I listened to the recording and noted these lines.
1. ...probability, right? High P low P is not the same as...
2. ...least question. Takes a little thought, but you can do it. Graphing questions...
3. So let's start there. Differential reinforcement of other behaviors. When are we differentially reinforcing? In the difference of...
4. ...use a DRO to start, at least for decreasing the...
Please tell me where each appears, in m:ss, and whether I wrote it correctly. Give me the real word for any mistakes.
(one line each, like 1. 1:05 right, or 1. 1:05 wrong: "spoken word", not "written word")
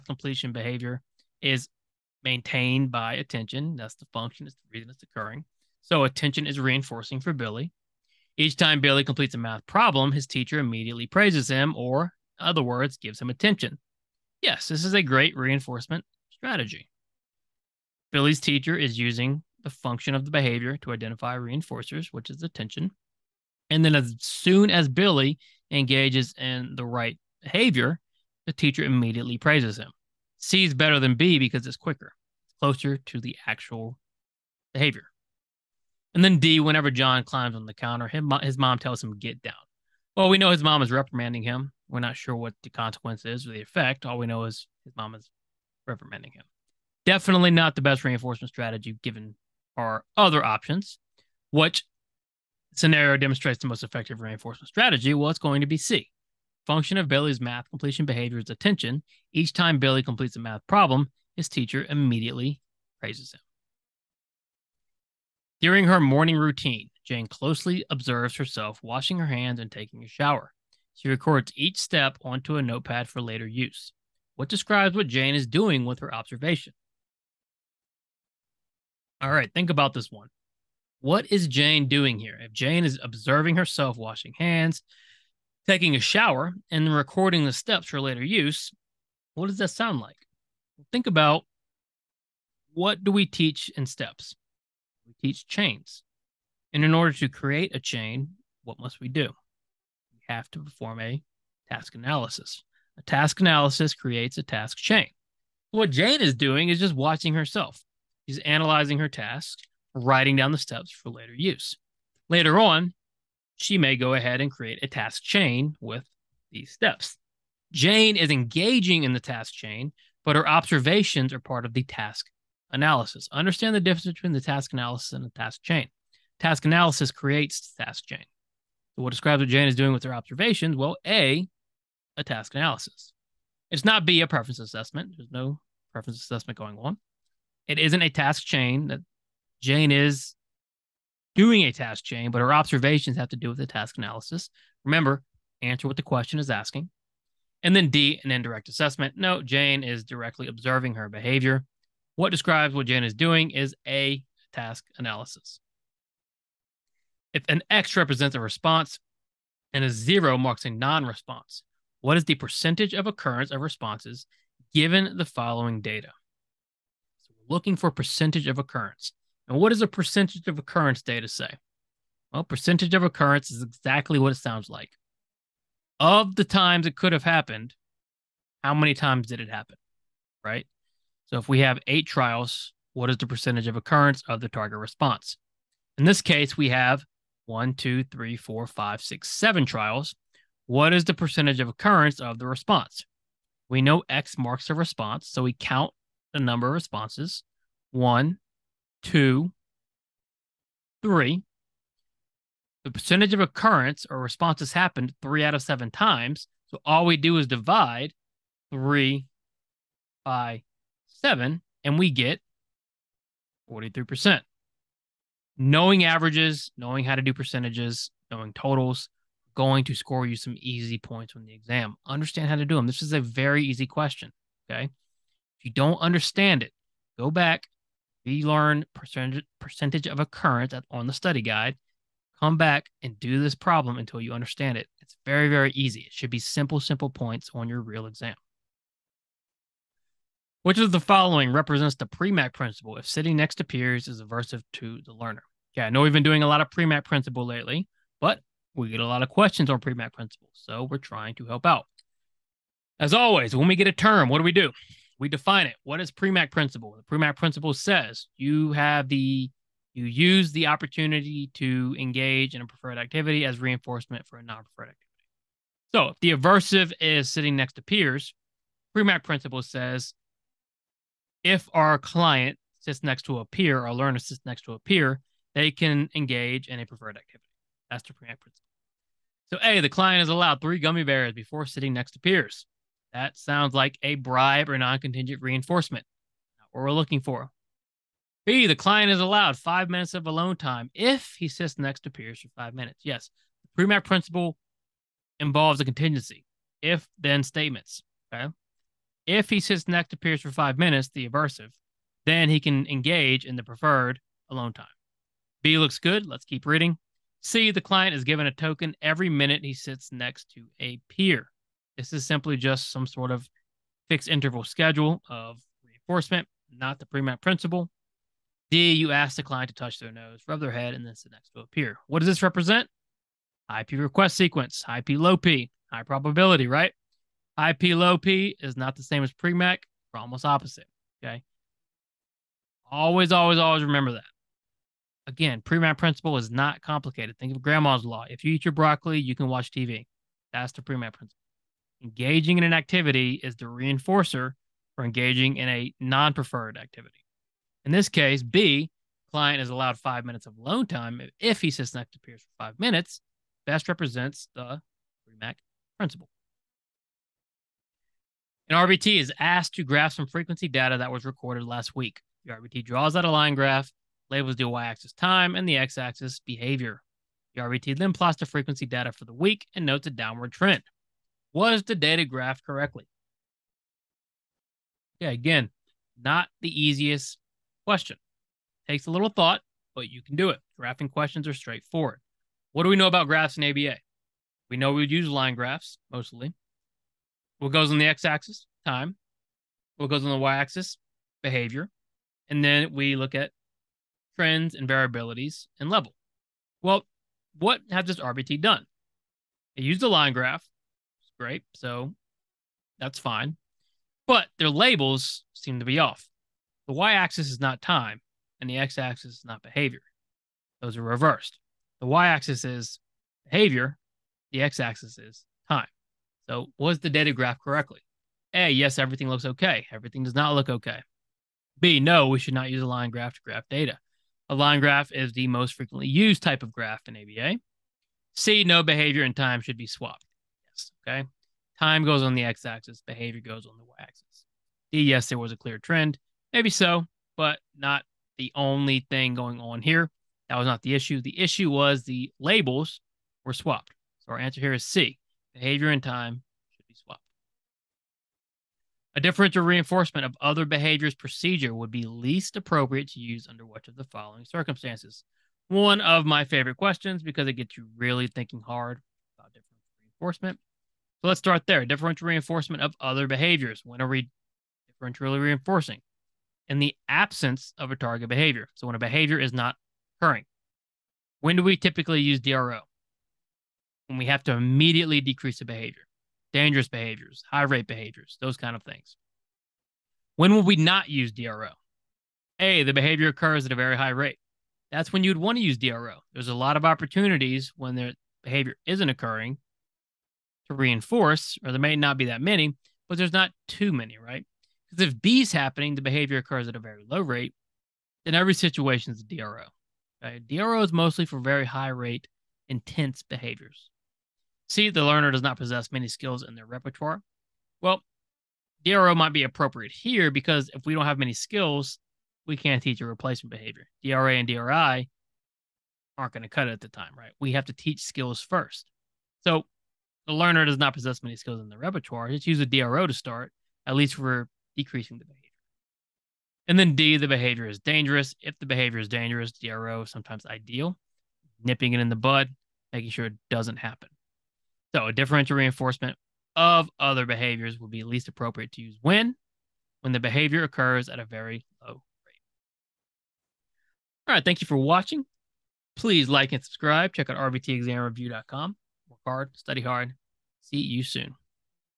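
1. 5:26 right
2. 6:16 wrong: "easiest", not "least"
3. 7:41 wrong: "absence", not "difference"
4. 8:42 right.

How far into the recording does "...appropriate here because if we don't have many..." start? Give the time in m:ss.
8:29.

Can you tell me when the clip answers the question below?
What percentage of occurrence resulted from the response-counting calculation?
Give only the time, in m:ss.
3:33.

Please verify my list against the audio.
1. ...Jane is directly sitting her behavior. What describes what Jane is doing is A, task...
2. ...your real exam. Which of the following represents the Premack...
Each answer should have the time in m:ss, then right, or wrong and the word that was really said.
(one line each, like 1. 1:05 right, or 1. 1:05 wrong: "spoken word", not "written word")
1. 2:29 wrong: "observing", not "sitting"
2. 3:57 right.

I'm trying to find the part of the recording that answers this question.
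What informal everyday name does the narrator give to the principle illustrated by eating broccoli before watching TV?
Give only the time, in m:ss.
5:37.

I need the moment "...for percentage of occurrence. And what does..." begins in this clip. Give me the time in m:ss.
2:47.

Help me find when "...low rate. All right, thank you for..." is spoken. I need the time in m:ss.
9:01.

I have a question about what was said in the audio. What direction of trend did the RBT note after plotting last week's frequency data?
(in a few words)
Downward.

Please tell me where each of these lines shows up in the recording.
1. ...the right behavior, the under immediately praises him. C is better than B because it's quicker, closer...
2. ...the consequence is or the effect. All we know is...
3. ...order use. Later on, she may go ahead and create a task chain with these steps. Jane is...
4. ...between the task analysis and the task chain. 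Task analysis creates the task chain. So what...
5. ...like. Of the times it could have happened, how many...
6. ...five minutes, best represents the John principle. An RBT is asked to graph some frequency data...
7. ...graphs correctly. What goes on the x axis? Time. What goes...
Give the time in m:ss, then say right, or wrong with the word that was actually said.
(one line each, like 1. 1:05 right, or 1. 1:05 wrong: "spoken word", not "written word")
1. 0:26 wrong: "teacher", not "under"
2. 0:42 right
3. 1:51 wrong: "later", not "order"
4. 2:04 right
5. 2:54 right
6. 5:52 wrong: "Premack", not "John"
7. 6:25 wrong: "mostly", not "correctly".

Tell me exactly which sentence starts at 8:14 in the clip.
Because if B is happening, the behavior occurs at a very low rate, then every situation is a DRO.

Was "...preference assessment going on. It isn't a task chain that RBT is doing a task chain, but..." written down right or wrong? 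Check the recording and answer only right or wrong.
wrong.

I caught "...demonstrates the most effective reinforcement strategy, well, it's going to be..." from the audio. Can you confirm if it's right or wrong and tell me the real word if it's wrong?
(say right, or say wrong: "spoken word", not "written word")
right.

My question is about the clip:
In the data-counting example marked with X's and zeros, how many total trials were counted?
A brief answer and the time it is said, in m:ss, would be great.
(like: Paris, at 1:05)
7, at 3:09.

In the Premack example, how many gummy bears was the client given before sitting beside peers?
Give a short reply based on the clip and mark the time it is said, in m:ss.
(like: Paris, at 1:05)
3, at 4:40.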